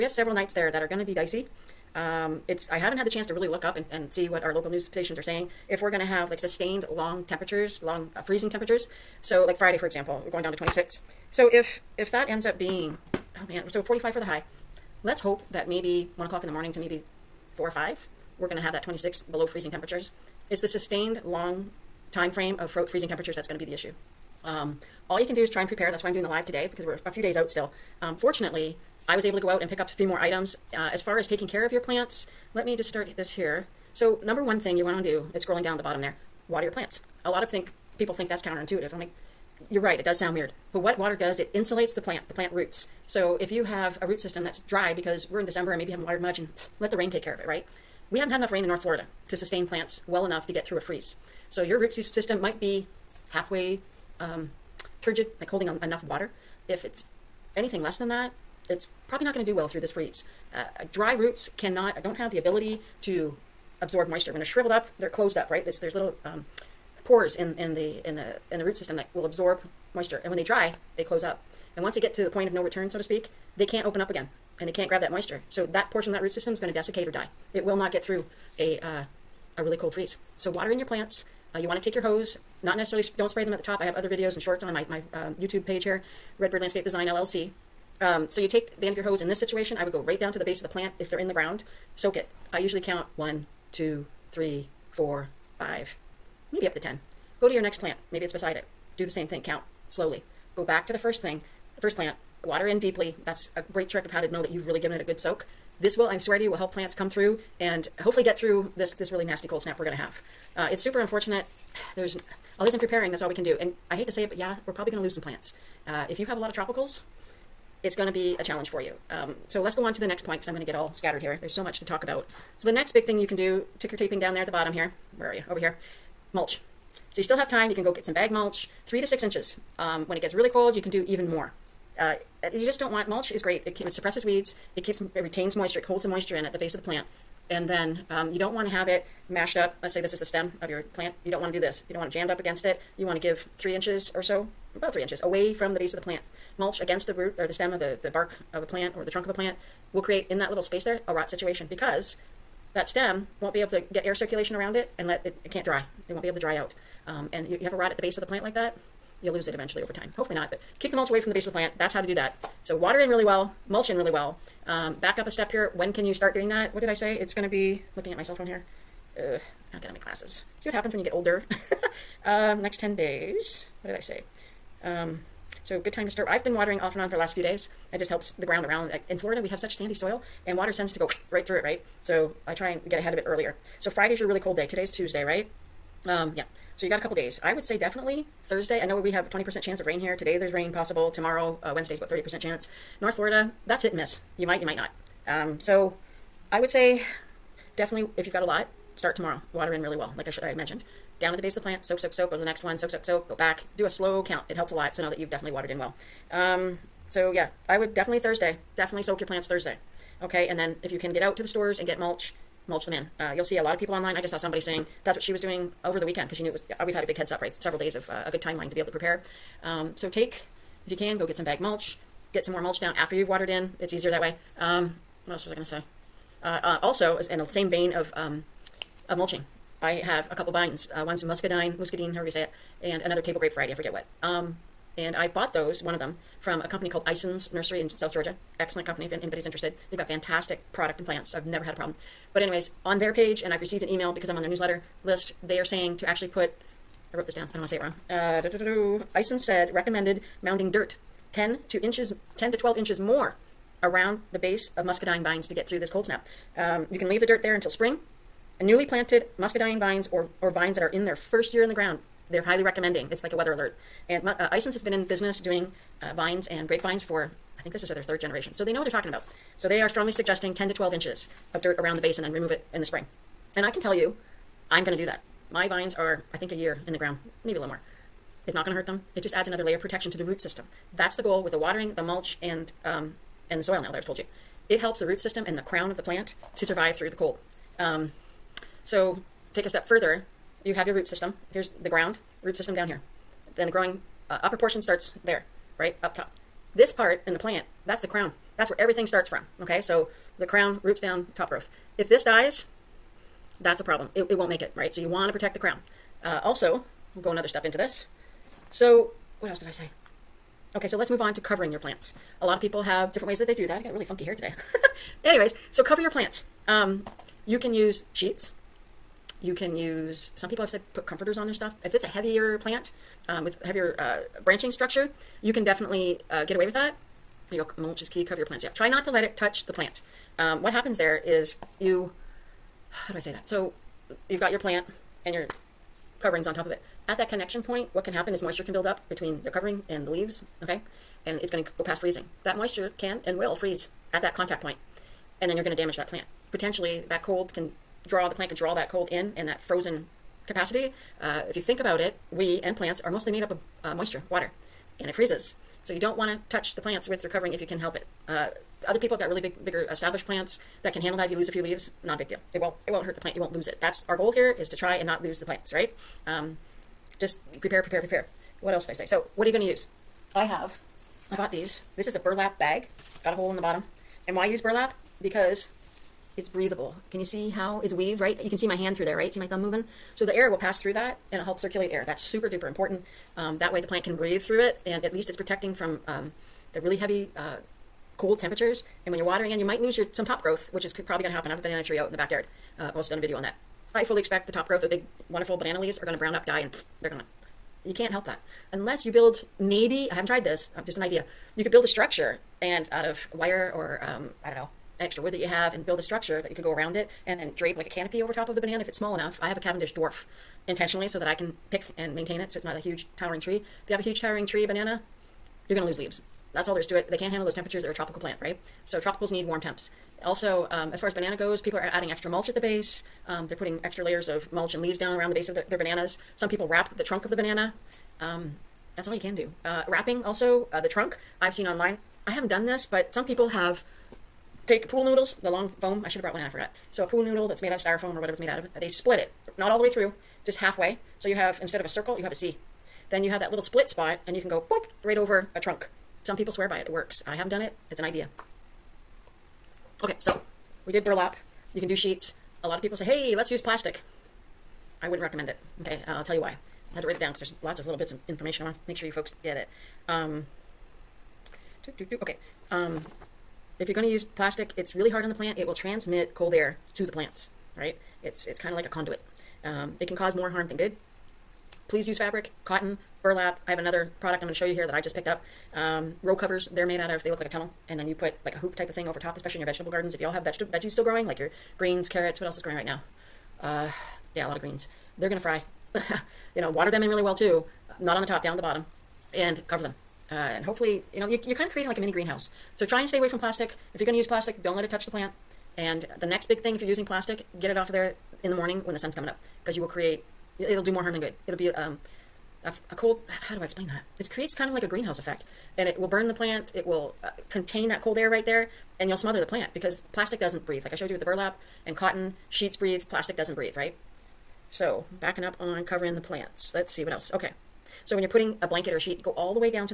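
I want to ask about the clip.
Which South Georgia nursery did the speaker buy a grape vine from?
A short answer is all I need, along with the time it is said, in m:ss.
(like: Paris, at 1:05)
Ison's Nursery, at 3:57.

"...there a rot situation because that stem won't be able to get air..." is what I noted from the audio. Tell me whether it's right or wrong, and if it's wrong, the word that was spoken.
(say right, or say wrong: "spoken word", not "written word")
right.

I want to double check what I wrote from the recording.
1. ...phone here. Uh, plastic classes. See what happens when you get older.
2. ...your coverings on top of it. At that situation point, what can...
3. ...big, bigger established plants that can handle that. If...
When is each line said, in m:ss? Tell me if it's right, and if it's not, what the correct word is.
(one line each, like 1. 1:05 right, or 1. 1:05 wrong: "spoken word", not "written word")
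1. 2:48 wrong: "academic", not "plastic"
2. 5:35 wrong: "connection", not "situation"
3. 5:59 right.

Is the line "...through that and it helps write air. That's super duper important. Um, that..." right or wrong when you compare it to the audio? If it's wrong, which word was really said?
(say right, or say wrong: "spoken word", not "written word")
wrong: "circulate", not "write".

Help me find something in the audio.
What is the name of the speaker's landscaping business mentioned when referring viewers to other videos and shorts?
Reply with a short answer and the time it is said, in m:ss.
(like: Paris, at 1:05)
Redbird Landscape Design LLC, at 1:26.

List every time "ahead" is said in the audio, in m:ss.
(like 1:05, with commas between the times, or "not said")
3:02.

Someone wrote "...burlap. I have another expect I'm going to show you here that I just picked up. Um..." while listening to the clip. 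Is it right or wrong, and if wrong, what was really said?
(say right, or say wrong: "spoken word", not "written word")
wrong: "product", not "expect".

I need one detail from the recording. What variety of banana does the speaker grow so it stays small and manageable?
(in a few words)
Cavendish dwarf.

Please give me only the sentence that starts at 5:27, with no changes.
You go, mulch is key, cover your plants.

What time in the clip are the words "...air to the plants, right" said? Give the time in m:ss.
7:46.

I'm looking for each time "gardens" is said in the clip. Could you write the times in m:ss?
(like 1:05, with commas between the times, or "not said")
7:59.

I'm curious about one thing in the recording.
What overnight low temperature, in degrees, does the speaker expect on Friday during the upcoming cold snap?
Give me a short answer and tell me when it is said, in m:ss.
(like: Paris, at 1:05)
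26, at 0:10.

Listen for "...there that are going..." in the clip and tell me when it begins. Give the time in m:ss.
0:00.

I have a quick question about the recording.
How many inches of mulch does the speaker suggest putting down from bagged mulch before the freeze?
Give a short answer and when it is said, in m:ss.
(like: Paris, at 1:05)
3 to 6 inches, at 2:08.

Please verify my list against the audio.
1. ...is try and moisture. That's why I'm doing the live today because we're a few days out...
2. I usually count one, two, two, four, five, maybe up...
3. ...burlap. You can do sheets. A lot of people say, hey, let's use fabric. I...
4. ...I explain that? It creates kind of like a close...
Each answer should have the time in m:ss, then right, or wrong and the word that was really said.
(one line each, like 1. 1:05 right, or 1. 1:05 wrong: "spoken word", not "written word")
1. 0:25 wrong: "prepare", not "moisture"
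2. 1:32 wrong: "three", not "two"
3. 7:31 wrong: "plastic", not "fabric"
4. 8:23 wrong: "greenhouse", not "close".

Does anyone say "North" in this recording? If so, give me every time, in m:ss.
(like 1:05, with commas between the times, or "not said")
0:48, 3:13.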